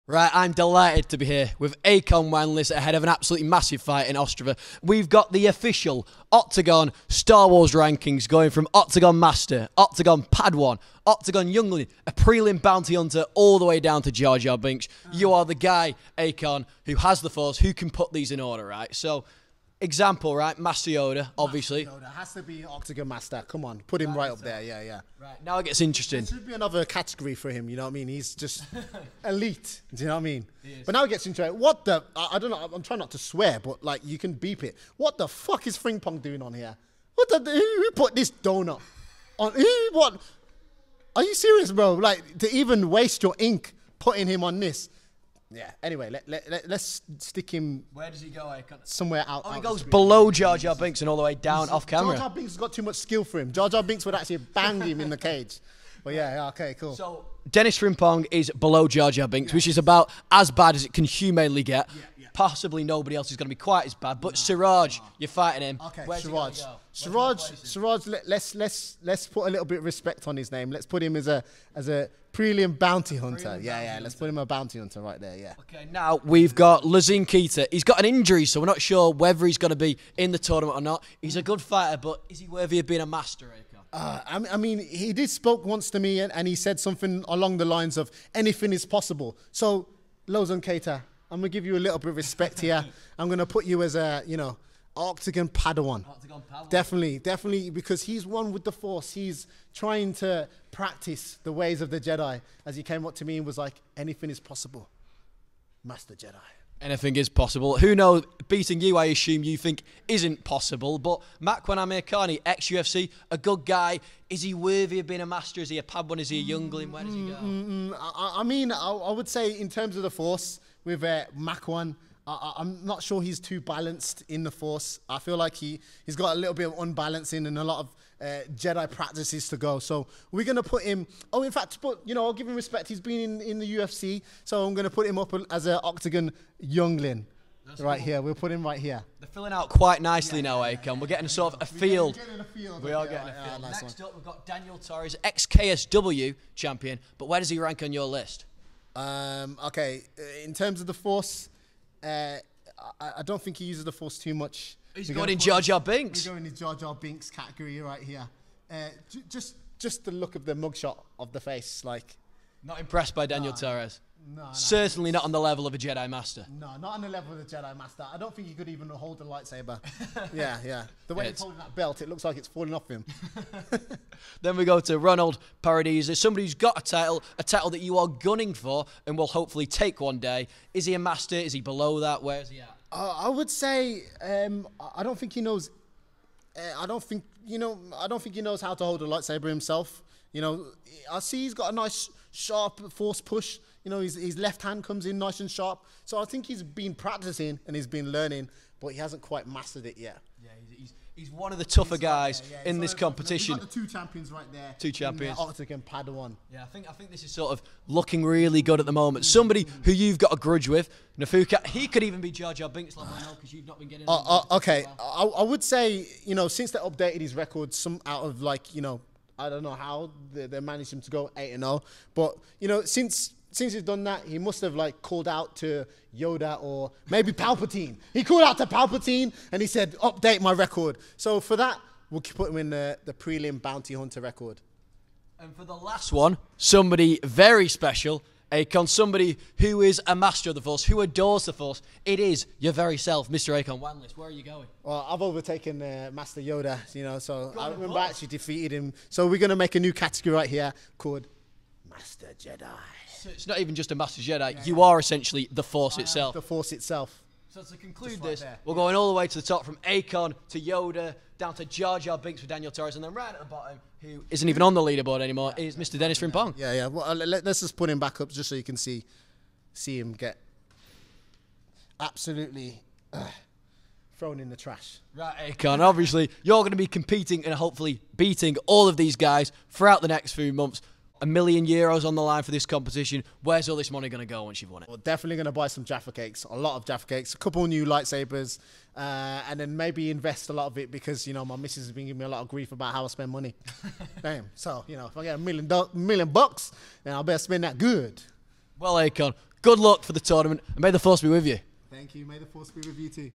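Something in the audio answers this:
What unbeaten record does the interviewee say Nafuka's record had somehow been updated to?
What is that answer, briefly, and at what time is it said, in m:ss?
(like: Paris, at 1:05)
8 and 0, at 3:41.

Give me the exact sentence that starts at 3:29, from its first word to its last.
Somebody who you've got a grudge with, Nafuka.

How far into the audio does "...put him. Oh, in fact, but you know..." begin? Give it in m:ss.
2:10.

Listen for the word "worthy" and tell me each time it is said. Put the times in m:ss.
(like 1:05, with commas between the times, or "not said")
1:22, 1:54.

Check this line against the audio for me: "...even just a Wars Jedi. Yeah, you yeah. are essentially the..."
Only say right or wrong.
wrong.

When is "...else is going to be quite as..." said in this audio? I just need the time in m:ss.
1:03.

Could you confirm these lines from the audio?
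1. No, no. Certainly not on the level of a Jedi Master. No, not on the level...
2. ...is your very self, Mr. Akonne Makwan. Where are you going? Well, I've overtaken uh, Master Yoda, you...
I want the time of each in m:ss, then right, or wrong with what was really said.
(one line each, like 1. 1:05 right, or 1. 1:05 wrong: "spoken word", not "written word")
1. 2:44 right
2. 4:02 wrong: "Wanliss", not "Makwan".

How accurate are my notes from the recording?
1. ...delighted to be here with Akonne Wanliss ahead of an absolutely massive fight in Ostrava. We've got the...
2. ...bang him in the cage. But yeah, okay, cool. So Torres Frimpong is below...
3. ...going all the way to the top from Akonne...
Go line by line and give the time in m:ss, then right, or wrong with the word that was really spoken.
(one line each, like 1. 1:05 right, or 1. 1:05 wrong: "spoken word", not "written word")
1. 0:00 right
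2. 0:54 wrong: "Denis", not "Torres"
3. 4:18 right.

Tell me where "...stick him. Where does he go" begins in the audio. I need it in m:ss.
0:47.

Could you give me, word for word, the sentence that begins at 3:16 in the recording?
So I think he's been practicing and he's been learning, but he hasn't quite mastered it yet.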